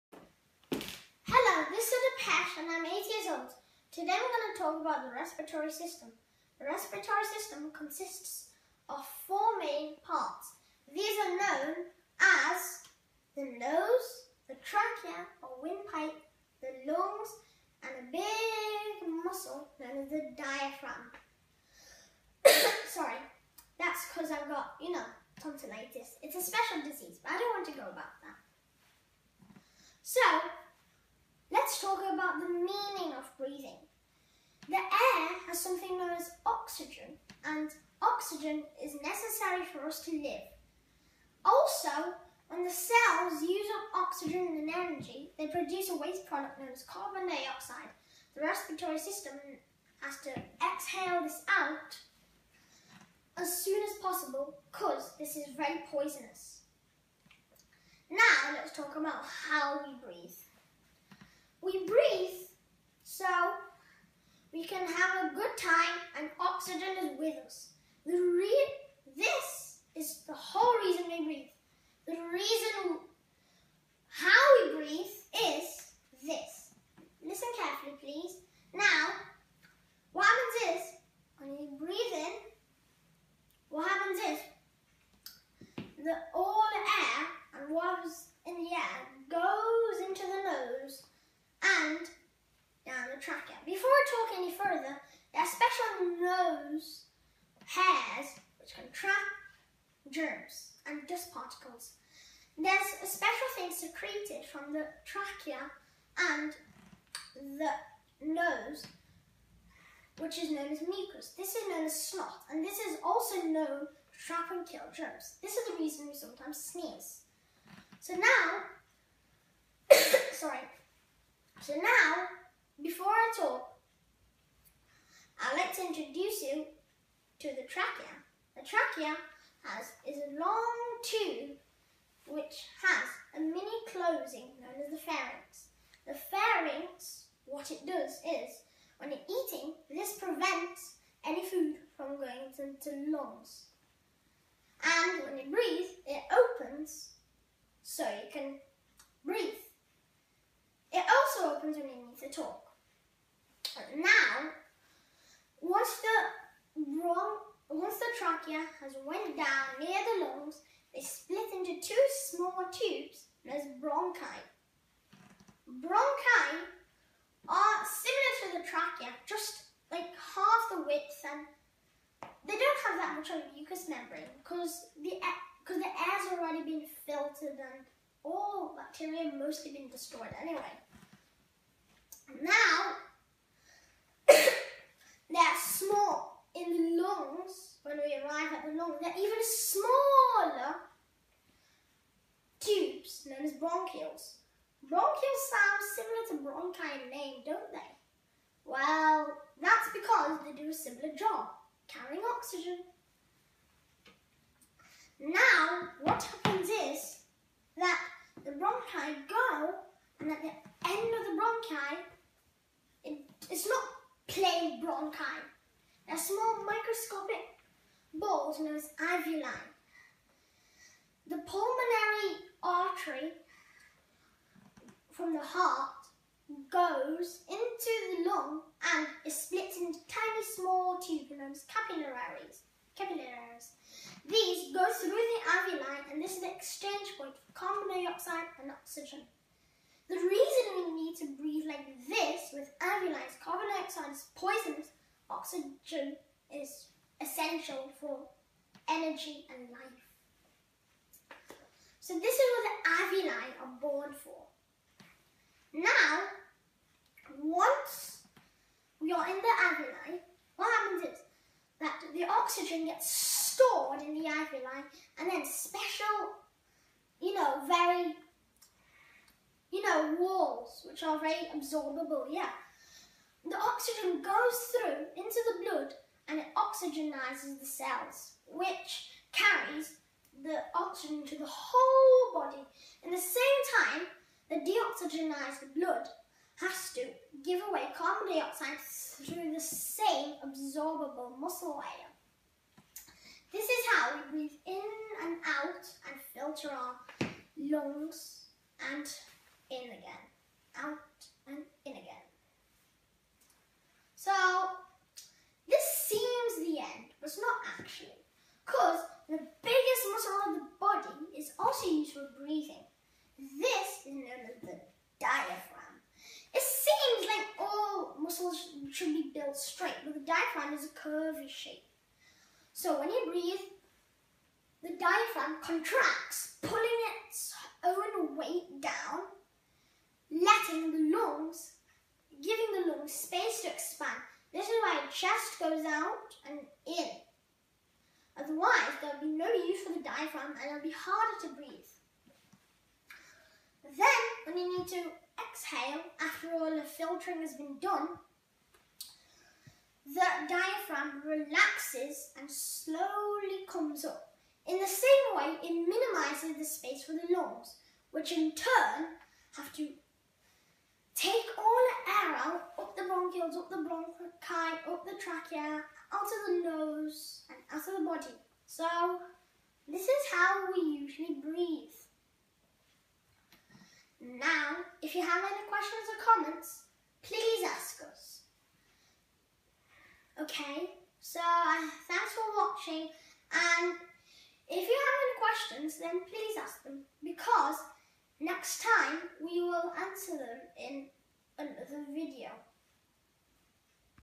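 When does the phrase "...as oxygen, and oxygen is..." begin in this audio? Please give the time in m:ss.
0:36.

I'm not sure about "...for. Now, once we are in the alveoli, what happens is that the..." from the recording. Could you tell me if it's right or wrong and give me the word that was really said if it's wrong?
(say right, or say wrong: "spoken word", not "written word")
right.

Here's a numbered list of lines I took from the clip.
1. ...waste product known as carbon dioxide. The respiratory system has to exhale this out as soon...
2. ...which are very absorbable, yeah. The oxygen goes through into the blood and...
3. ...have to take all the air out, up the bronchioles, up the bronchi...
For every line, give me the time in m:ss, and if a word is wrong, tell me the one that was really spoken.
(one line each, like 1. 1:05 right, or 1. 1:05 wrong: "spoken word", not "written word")
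1. 0:45 right
2. 4:30 right
3. 5:59 right.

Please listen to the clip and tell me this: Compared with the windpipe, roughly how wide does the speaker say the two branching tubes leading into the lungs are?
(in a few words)
half the width.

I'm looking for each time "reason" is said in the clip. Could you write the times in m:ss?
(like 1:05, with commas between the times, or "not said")
1:55, 4:00.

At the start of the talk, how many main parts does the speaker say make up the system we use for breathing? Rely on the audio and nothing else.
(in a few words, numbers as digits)
4.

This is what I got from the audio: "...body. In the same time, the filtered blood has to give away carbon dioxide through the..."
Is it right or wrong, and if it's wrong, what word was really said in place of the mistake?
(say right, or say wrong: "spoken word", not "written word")
wrong: "deoxygenized", not "filtered".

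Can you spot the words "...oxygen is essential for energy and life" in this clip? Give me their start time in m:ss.
4:05.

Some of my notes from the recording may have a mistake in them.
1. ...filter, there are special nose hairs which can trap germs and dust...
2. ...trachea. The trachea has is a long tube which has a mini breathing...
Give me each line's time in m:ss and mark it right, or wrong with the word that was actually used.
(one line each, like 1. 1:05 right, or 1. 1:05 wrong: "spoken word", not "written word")
1. 1:34 wrong: "further", not "filter"
2. 2:07 wrong: "closing", not "breathing".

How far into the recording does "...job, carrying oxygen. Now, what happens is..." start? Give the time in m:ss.
3:21.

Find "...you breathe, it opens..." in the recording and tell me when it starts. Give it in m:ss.
2:25.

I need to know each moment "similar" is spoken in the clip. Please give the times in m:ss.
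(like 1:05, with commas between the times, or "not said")
2:47, 3:15, 3:20.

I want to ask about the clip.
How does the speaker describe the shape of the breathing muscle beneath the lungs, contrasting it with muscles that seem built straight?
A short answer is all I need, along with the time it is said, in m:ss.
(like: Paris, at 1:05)
curvy, at 5:20.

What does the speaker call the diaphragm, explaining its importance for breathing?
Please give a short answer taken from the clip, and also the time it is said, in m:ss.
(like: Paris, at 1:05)
biggest muscle, at 5:09.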